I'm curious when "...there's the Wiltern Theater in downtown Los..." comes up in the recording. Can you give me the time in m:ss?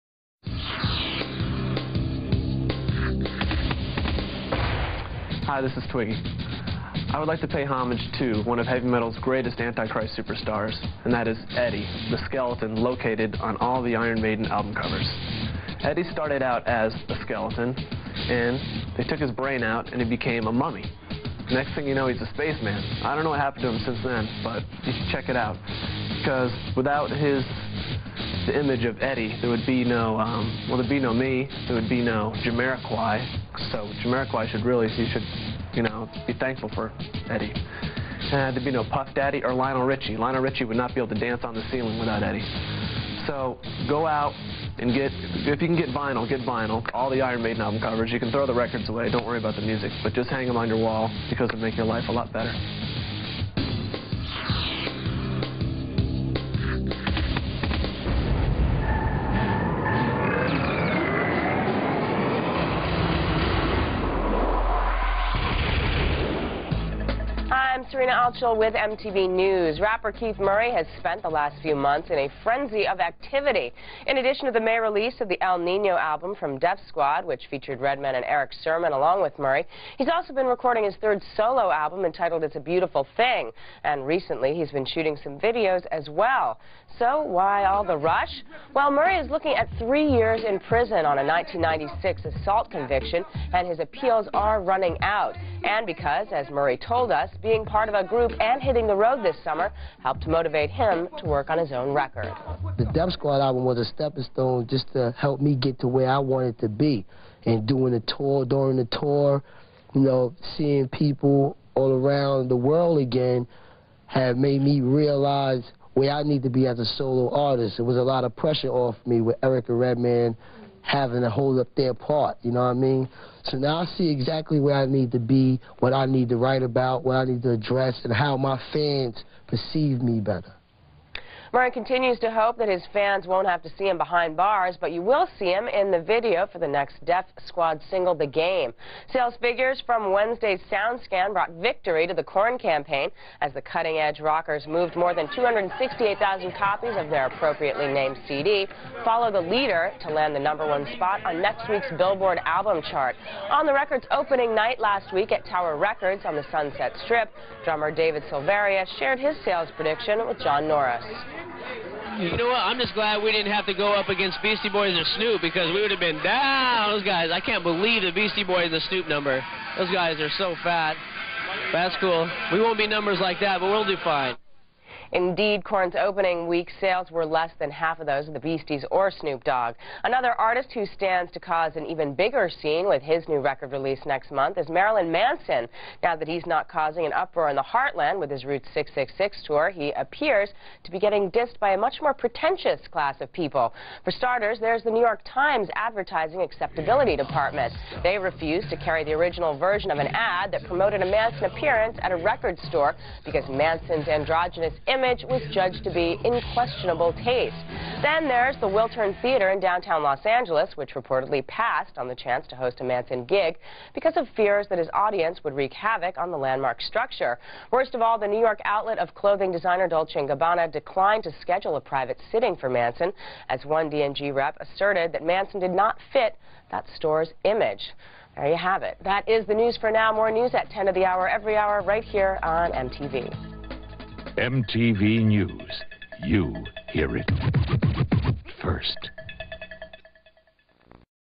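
3:28.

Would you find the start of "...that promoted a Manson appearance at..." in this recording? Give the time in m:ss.
3:20.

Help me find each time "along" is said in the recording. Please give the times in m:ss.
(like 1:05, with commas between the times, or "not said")
1:18.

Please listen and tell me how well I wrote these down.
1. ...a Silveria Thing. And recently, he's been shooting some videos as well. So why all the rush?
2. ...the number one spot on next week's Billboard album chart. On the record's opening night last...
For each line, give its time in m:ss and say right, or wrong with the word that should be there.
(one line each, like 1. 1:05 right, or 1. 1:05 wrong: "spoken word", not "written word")
1. 1:22 wrong: "Beautiful", not "Silveria"
2. 2:30 right.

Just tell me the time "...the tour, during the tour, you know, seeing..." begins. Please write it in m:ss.
1:47.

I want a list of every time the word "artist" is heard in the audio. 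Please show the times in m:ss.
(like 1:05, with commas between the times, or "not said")
1:57, 3:00.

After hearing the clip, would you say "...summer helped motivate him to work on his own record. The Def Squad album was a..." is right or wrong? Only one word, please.
right.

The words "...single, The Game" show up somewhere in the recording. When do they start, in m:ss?
2:17.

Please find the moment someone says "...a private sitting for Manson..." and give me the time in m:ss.
3:41.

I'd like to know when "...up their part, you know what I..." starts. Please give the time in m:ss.
2:01.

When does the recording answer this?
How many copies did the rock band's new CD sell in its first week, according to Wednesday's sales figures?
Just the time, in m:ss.
2:25.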